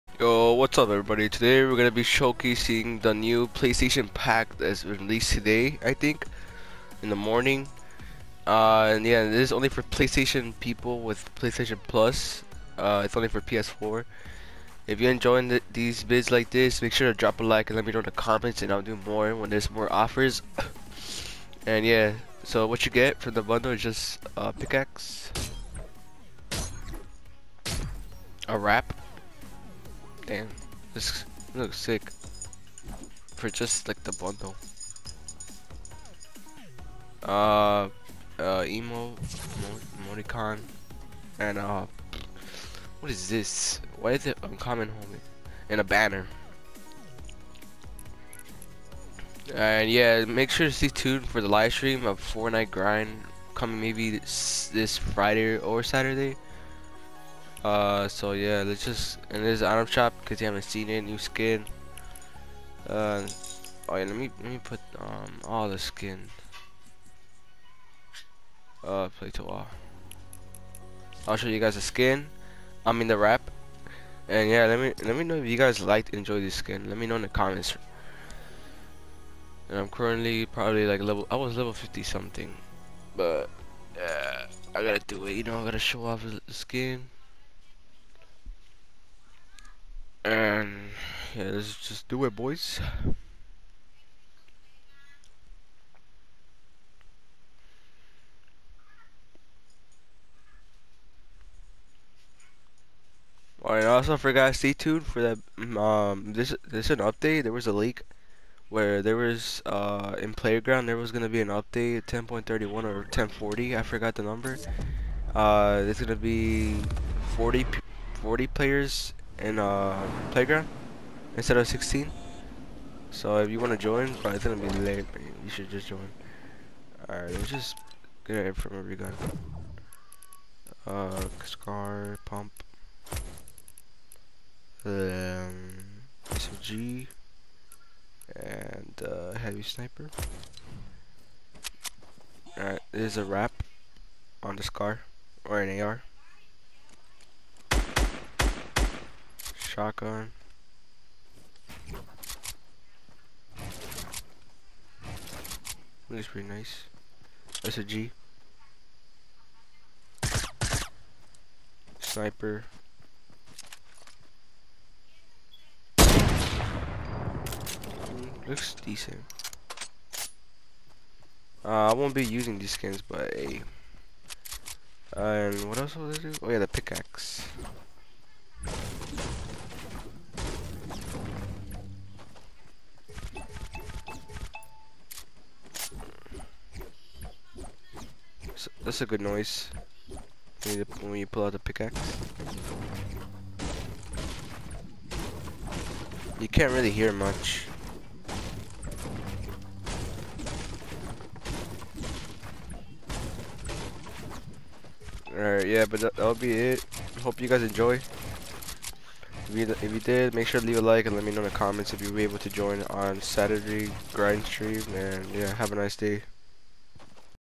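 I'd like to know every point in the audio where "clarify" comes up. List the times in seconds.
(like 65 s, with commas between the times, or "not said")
not said.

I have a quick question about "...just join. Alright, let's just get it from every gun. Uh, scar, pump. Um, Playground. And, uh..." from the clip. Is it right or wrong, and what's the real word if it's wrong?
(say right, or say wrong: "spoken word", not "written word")
wrong: "SMG", not "Playground".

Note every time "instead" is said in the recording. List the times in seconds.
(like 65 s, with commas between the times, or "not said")
121 s.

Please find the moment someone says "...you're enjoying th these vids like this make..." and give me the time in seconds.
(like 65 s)
15 s.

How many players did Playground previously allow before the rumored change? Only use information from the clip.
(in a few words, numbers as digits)
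16.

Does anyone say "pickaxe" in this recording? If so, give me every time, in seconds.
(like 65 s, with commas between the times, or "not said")
24 s, 176 s, 191 s.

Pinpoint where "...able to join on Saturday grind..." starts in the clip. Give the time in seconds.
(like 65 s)
212 s.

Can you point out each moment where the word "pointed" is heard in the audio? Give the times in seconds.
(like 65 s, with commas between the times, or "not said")
not said.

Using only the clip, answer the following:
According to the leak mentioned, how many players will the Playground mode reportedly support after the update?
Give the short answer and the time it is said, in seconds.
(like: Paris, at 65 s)
40, at 117 s.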